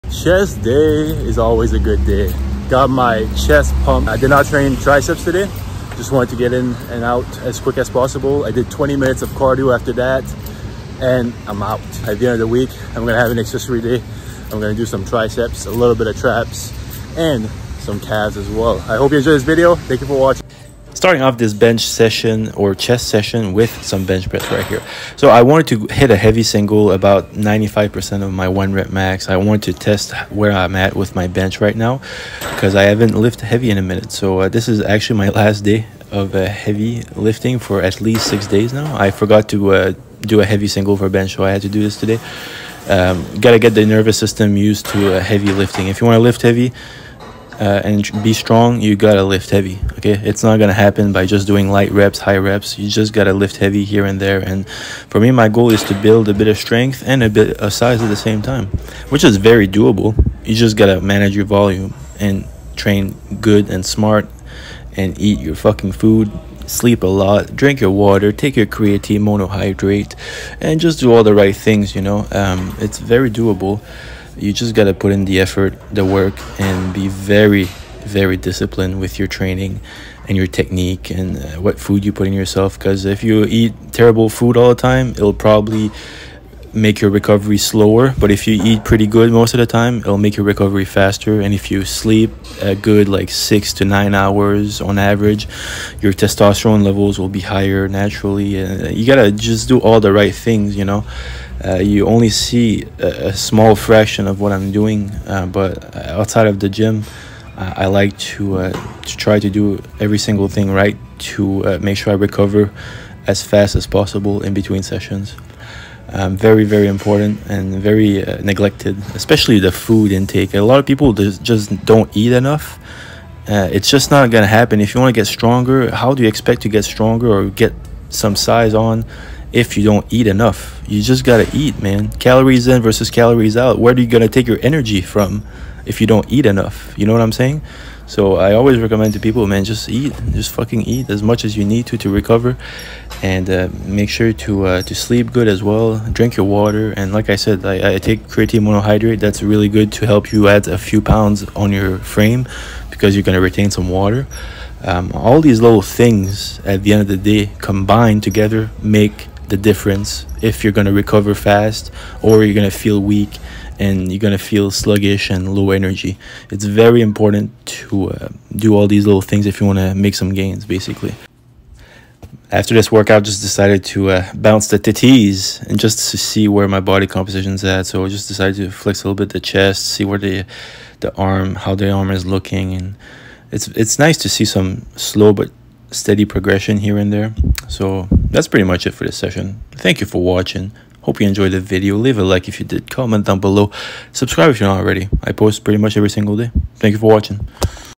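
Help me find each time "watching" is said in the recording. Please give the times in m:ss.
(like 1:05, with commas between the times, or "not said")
0:20, 3:10, 3:17.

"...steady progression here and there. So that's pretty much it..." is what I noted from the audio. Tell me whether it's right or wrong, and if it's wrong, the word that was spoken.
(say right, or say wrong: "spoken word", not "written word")
right.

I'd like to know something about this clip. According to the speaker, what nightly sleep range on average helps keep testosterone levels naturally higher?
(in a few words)
6 to 9 hours.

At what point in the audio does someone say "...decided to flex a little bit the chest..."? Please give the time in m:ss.
2:58.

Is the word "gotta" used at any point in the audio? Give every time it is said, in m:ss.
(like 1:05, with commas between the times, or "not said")
0:43, 0:48, 0:53, 1:00, 1:14, 1:39, 2:11.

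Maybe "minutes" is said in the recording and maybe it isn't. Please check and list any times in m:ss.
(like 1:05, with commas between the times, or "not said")
0:08, 0:33.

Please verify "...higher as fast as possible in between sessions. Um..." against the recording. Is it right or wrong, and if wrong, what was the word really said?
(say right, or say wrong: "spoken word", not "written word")
wrong: "recover", not "higher".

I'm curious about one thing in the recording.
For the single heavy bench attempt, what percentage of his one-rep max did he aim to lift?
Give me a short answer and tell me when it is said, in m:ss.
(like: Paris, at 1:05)
95%, at 0:27.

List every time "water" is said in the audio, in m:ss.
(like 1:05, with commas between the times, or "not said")
1:07, 2:26, 2:33.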